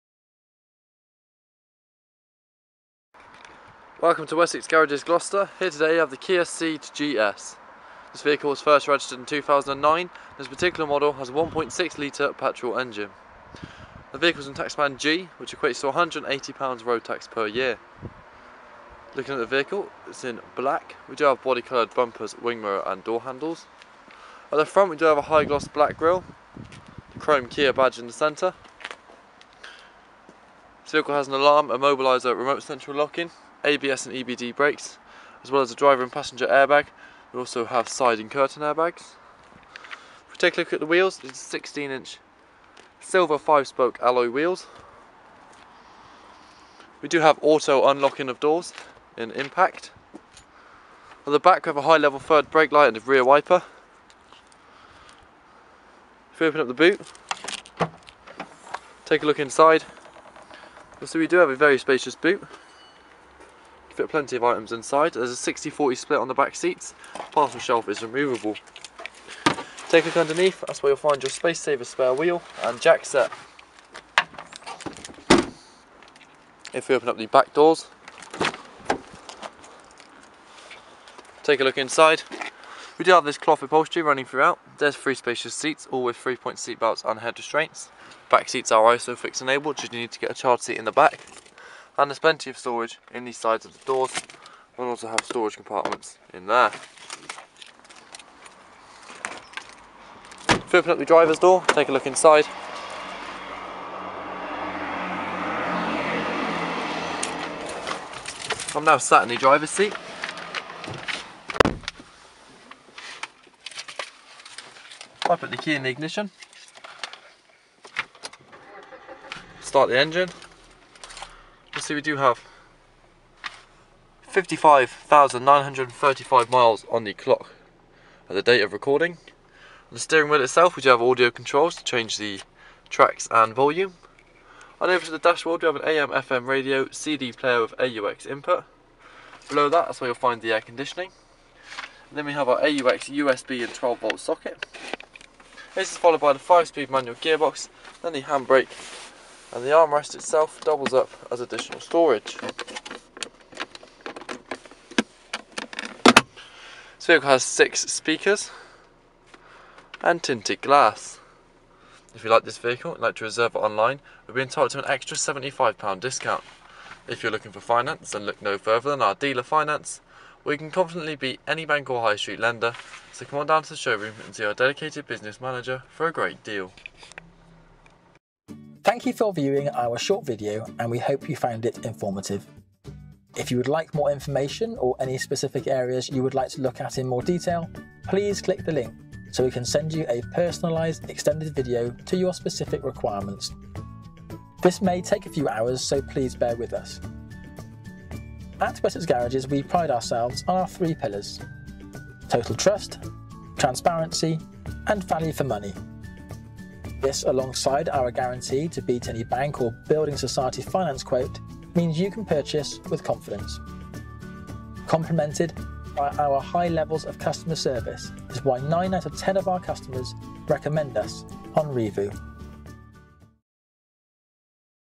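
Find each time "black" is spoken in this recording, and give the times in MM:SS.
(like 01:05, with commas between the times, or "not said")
00:20, 00:25.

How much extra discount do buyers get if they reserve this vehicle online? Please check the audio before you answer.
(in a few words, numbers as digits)
£75.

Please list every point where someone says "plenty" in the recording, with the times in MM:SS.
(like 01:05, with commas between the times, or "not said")
01:04, 01:32.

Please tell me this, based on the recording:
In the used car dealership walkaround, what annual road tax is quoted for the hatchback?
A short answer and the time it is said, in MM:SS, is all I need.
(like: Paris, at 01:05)
£180, at 00:16.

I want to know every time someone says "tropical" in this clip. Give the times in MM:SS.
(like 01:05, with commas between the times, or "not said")
not said.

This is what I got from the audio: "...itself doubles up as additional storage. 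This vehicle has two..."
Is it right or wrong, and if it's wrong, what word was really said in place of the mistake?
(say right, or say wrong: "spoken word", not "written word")
wrong: "six", not "two".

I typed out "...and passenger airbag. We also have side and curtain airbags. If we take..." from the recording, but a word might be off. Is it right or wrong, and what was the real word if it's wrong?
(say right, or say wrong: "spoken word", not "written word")
right.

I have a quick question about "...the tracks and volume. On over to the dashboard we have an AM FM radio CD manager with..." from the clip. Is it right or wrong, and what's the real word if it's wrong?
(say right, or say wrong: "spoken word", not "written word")
wrong: "player", not "manager".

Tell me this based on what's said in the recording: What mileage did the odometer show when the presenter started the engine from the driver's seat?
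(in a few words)
55,935 miles.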